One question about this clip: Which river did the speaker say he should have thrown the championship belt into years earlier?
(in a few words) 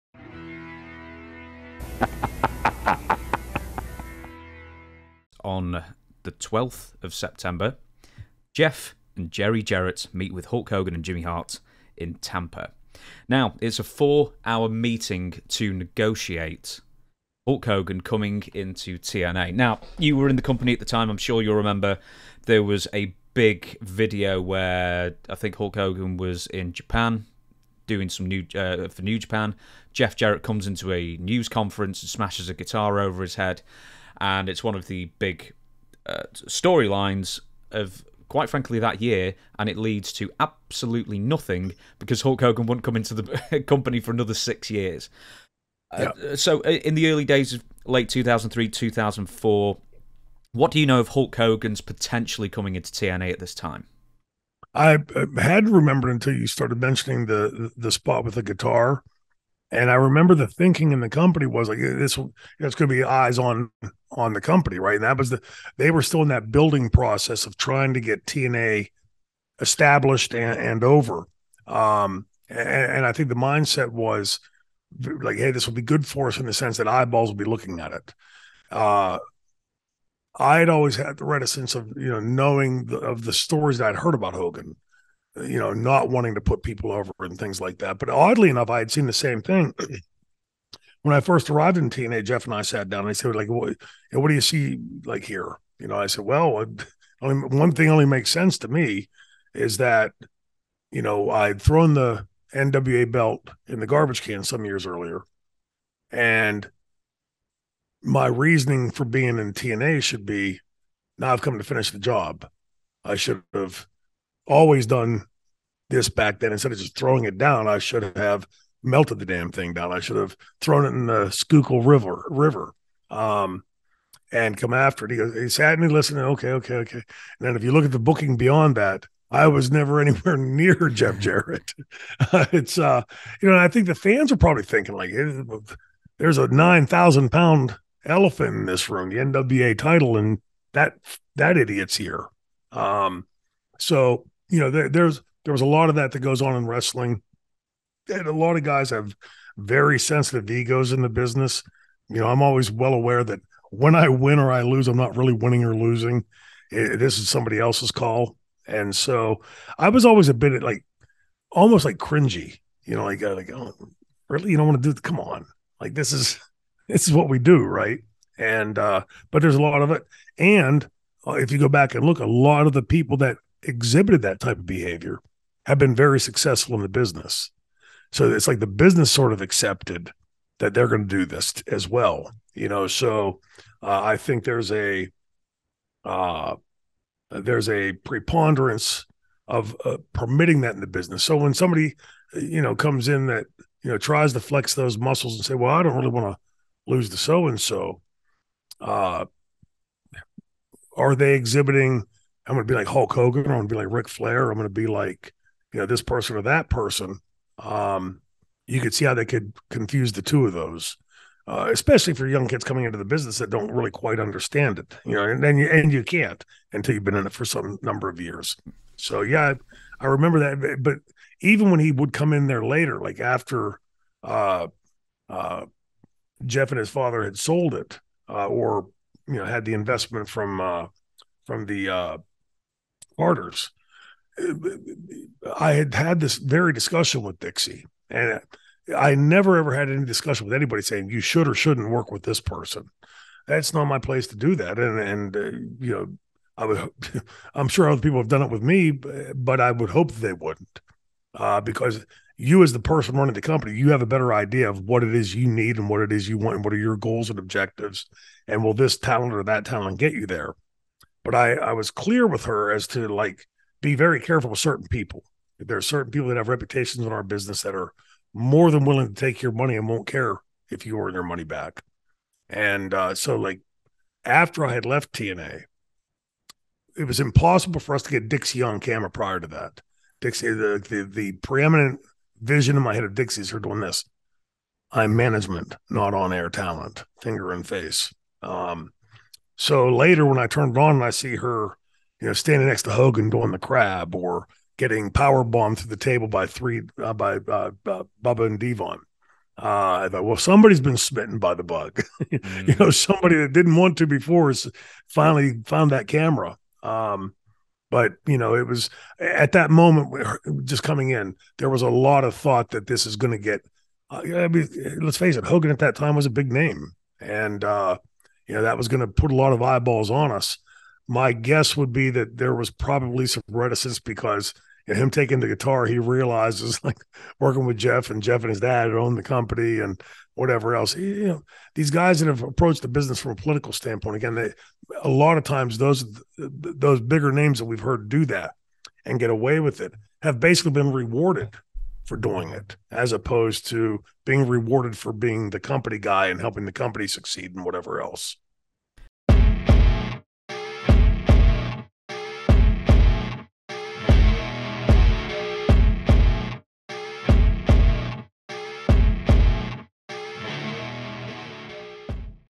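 Schuylkill River.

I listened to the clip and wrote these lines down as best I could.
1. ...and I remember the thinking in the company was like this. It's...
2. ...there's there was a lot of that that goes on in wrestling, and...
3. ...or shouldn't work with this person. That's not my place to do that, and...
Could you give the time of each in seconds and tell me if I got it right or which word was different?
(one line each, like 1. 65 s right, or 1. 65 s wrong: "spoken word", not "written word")
1. 59 s right
2. 144 s right
3. 241 s right.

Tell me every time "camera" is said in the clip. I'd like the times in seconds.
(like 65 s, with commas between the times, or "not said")
278 s, 306 s.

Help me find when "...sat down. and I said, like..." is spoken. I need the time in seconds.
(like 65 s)
92 s.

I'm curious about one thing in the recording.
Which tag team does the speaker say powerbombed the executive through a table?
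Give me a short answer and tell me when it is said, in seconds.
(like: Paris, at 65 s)
Bubba and Devon, at 298 s.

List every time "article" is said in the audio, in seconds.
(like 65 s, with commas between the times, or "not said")
not said.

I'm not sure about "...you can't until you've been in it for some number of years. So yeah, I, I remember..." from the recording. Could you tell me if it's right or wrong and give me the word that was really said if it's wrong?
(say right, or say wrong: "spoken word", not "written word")
right.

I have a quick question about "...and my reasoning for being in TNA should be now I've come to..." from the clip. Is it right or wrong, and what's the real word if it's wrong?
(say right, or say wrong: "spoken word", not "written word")
right.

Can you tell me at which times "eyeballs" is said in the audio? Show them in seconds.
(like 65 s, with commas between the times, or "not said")
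76 s, 319 s.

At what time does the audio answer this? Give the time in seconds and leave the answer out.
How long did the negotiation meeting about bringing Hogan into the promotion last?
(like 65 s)
13 s.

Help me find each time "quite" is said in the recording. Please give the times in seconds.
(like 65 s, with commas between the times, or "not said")
38 s, 213 s.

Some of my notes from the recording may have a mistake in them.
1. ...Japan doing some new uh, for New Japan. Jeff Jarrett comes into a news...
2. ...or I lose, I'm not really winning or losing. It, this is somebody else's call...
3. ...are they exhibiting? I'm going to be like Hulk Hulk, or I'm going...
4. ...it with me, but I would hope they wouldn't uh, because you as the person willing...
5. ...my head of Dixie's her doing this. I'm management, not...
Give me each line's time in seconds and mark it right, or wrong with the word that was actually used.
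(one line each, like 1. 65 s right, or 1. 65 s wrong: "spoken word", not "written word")
1. 26 s right
2. 154 s right
3. 200 s wrong: "Hogan", not "Hulk"
4. 248 s wrong: "running", not "willing"
5. 282 s right.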